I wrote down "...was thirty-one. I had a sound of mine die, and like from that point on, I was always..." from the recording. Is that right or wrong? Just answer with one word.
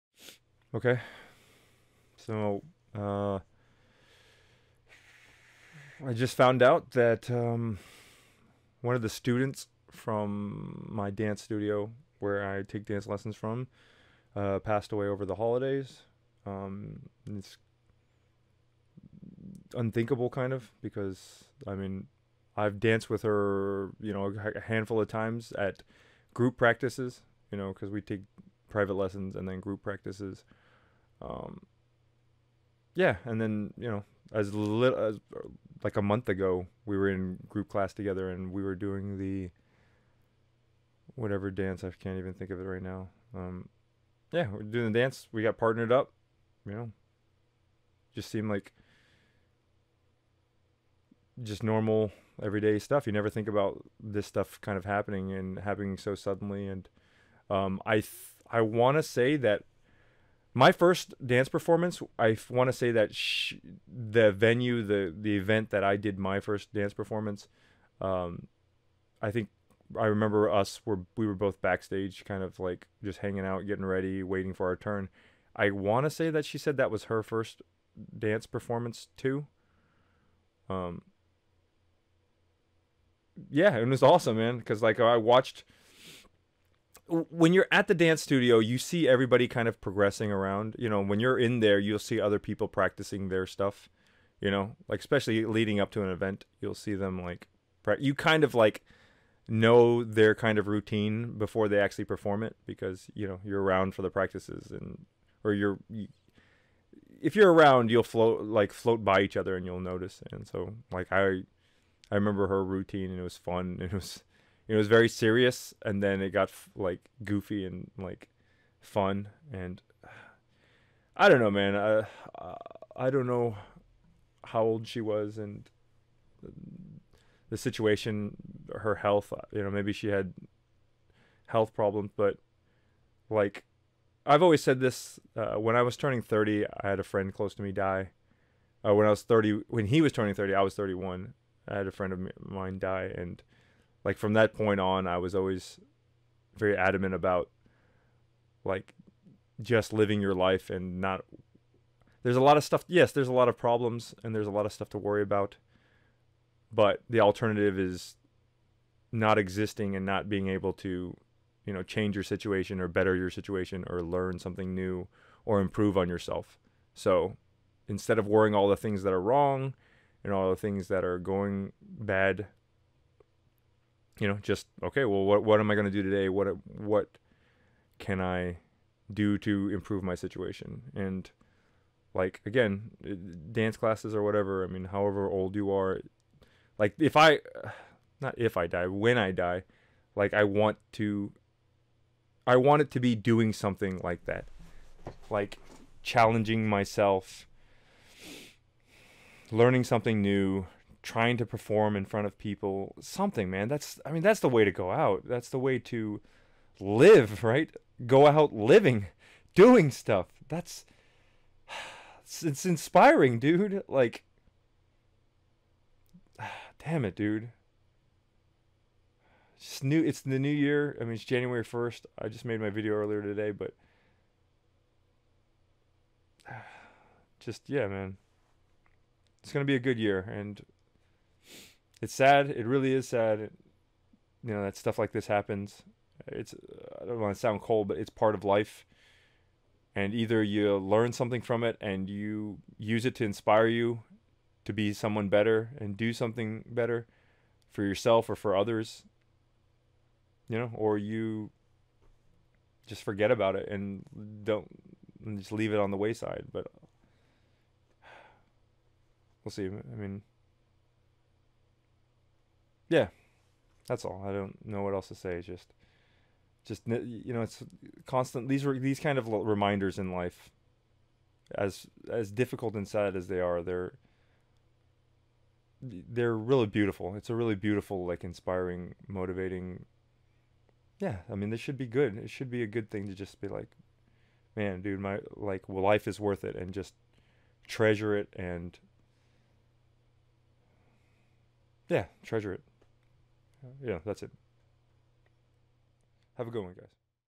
wrong.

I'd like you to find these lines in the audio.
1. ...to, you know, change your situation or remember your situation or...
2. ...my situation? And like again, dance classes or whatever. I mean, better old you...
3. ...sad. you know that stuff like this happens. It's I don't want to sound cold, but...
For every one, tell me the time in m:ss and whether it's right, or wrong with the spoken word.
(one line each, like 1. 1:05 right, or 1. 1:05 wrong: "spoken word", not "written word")
1. 2:40 wrong: "better", not "remember"
2. 3:00 wrong: "however", not "better"
3. 3:53 right.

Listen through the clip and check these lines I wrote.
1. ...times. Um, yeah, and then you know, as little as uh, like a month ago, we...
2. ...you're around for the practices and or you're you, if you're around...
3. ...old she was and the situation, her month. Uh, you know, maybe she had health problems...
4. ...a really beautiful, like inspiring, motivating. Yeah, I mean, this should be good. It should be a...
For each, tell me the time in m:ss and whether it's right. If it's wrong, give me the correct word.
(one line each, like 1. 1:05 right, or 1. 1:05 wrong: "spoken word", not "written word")
1. 0:29 wrong: "practices", not "times"
2. 1:43 right
3. 2:04 wrong: "health", not "month"
4. 4:37 right.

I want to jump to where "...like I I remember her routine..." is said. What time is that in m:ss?
1:50.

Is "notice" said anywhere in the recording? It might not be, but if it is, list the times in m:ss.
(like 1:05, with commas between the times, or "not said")
1:49.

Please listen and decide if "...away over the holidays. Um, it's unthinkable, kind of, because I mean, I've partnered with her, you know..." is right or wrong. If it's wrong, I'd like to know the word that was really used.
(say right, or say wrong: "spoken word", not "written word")
wrong: "danced", not "partnered".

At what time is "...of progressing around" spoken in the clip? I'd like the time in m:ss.
1:29.